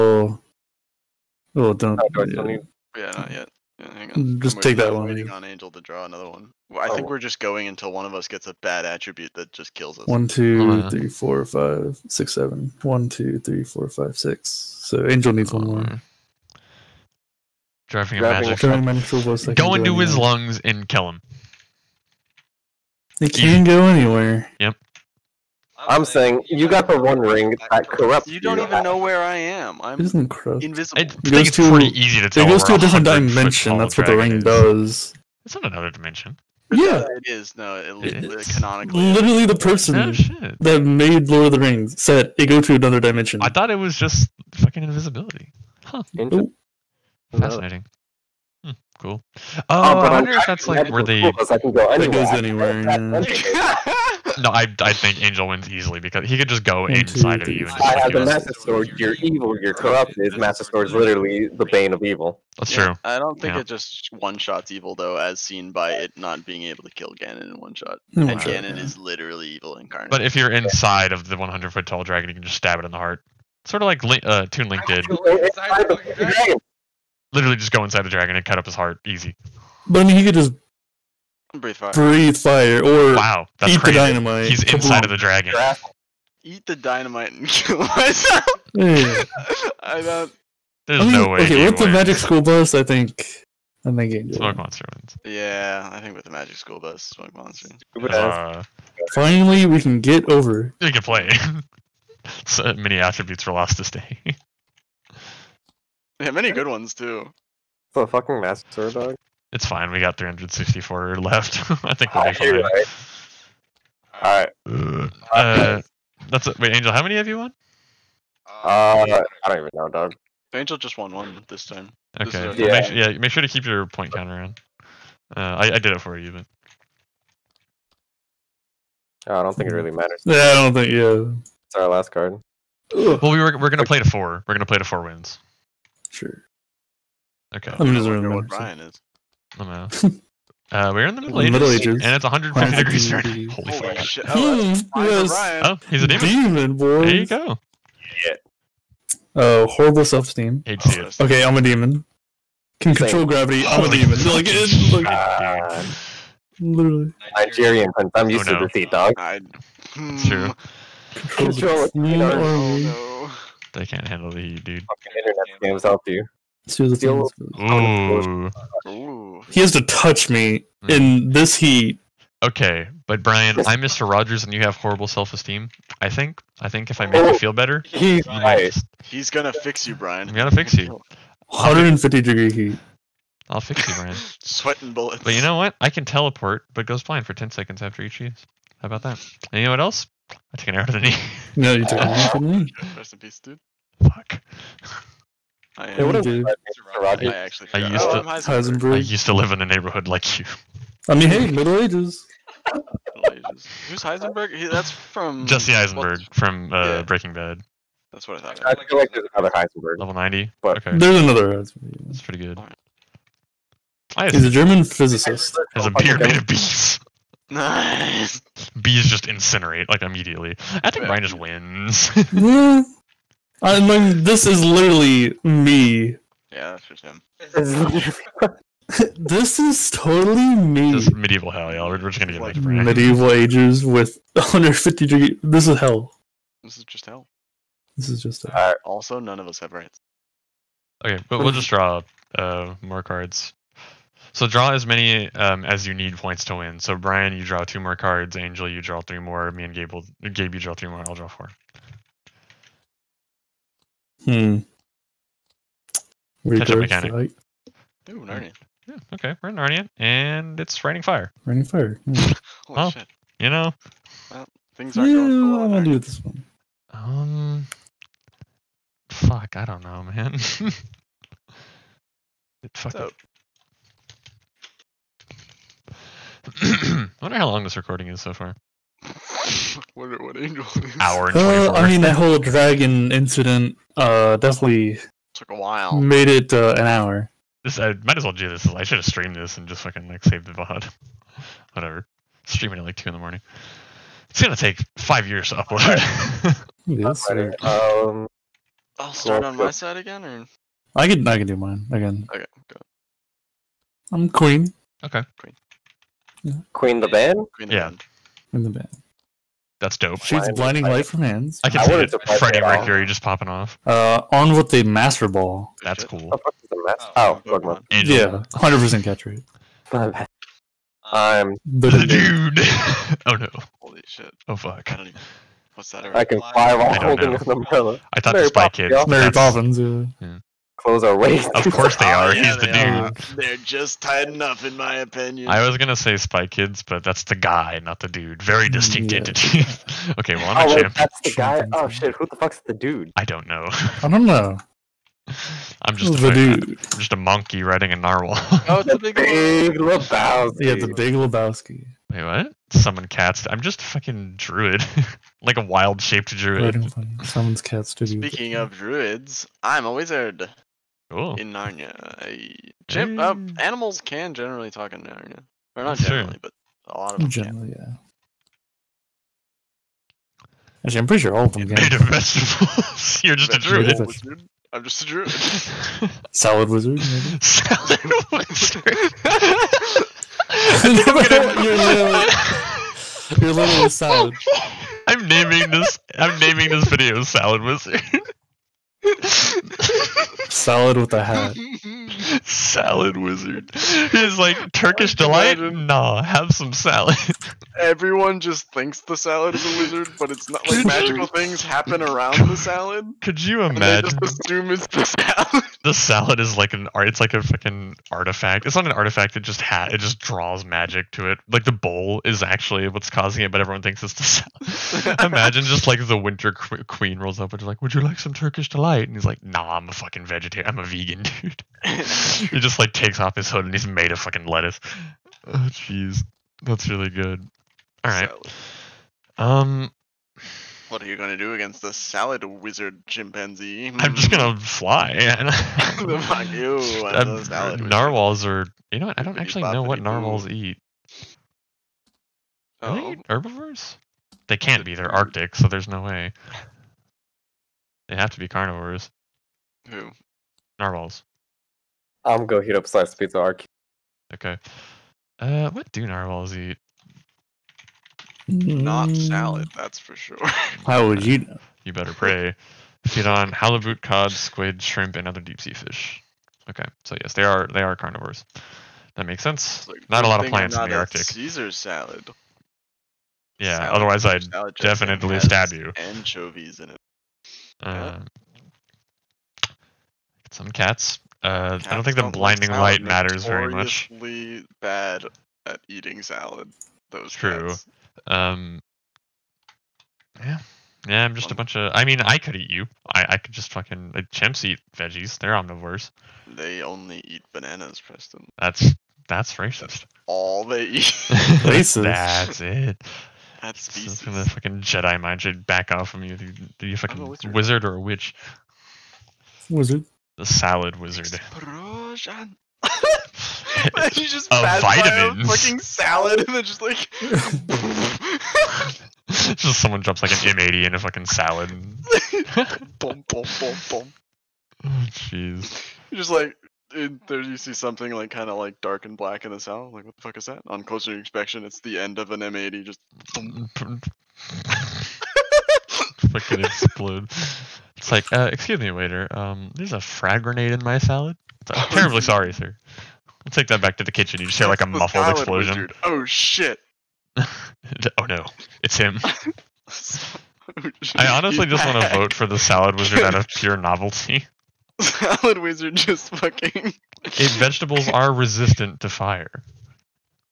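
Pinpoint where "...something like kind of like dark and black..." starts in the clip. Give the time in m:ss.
8:47.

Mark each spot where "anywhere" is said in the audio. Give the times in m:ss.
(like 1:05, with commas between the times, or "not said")
0:23, 0:52.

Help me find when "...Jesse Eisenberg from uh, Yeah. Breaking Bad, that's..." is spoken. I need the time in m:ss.
3:25.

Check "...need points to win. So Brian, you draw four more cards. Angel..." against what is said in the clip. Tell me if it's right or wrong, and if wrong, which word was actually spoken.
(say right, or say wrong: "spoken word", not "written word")
wrong: "two", not "four".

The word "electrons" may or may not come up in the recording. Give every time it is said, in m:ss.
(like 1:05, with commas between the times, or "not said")
not said.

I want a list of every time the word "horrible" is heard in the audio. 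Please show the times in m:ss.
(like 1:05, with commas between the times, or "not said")
2:29, 2:54.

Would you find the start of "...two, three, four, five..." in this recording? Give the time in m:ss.
0:13.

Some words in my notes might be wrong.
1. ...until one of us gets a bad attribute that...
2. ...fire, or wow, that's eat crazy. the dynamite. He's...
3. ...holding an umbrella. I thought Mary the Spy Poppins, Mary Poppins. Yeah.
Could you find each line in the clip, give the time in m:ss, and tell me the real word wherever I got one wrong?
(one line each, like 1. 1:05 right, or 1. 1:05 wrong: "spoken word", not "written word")
1. 0:07 right
2. 1:22 right
3. 5:26 right.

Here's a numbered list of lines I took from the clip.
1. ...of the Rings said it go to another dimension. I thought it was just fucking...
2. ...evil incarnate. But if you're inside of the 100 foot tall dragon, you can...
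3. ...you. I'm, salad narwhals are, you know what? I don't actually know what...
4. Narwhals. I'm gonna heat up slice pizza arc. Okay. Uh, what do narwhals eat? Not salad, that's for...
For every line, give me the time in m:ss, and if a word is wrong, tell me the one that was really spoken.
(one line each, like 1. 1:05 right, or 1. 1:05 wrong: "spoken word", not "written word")
1. 0:41 right
2. 1:09 right
3. 7:16 right
4. 7:30 right.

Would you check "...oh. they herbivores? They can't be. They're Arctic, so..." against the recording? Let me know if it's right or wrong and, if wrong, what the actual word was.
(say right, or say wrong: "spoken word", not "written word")
right.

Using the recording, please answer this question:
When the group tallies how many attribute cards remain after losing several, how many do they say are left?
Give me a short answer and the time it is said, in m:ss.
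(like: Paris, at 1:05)
364, at 1:50.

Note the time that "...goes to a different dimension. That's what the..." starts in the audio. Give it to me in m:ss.
0:32.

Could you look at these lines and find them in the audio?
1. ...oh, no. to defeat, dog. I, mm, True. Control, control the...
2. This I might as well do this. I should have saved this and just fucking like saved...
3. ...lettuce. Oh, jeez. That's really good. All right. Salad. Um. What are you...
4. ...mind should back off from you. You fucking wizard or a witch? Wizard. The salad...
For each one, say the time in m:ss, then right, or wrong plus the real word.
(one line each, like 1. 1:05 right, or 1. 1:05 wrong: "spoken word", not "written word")
1. 2:38 right
2. 4:47 wrong: "streamed", not "saved"
3. 7:04 right
4. 8:25 right.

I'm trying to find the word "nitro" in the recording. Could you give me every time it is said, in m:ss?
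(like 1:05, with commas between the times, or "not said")
not said.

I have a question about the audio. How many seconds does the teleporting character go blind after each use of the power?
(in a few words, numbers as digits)
10.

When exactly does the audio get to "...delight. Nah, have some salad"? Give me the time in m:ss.
6:35.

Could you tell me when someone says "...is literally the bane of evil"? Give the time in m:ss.
1:00.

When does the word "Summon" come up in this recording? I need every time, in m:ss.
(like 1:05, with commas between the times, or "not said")
5:52, 5:57.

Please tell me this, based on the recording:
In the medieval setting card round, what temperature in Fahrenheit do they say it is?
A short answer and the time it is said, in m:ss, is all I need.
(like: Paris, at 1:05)
150 degrees, at 2:22.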